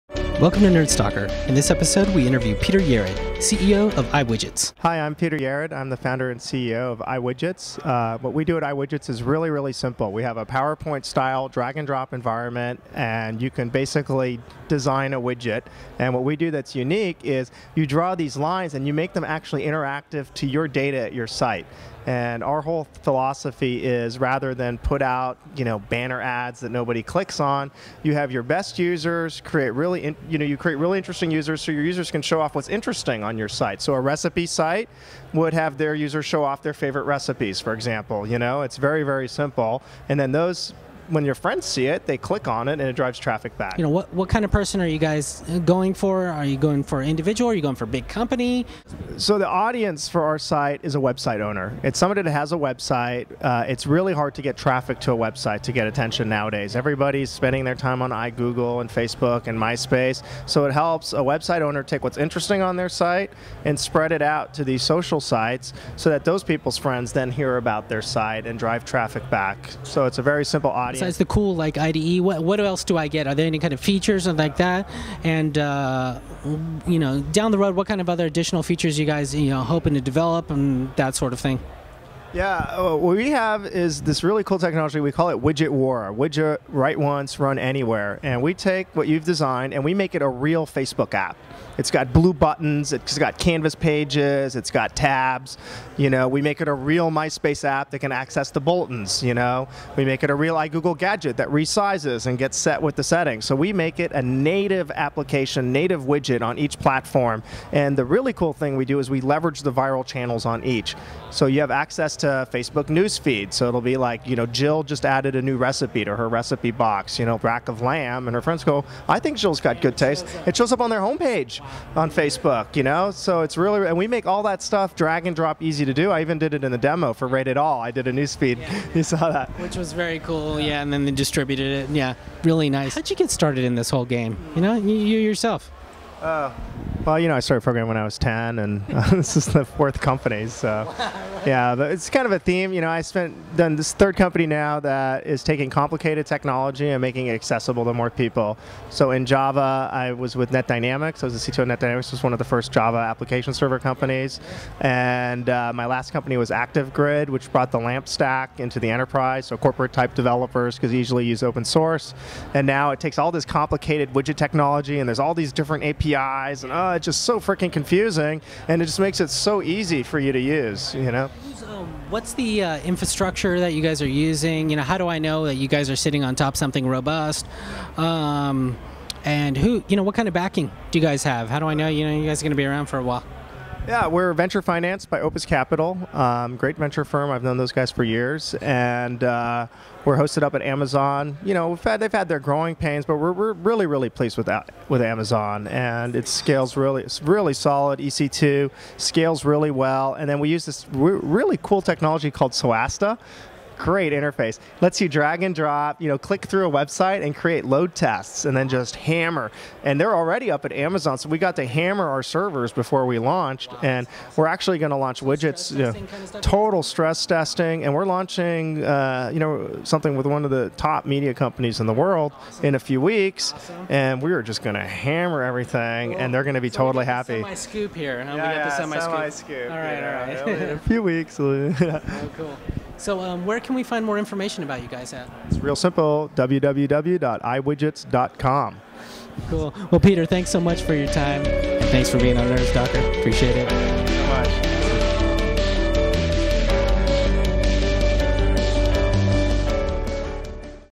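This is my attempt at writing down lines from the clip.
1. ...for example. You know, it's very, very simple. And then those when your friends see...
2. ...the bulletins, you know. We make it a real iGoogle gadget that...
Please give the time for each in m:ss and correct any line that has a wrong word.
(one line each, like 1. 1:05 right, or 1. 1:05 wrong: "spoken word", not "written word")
1. 0:37 right
2. 1:38 right.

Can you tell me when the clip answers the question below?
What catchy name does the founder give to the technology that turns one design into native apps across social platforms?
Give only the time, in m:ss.
1:25.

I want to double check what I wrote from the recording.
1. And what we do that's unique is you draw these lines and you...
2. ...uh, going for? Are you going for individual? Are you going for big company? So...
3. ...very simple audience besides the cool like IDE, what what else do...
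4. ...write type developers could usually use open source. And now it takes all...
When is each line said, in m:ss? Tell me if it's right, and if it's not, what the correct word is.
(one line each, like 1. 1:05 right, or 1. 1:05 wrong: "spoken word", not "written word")
1. 0:15 right
2. 0:45 right
3. 1:10 right
4. 2:39 wrong: "corporate", not "write".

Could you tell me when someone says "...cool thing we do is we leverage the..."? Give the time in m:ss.
1:48.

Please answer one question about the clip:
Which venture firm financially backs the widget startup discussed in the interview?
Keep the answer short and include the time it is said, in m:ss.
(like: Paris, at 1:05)
Opus Capital, at 3:05.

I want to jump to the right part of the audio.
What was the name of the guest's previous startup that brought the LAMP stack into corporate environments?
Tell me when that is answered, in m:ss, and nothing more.
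2:36.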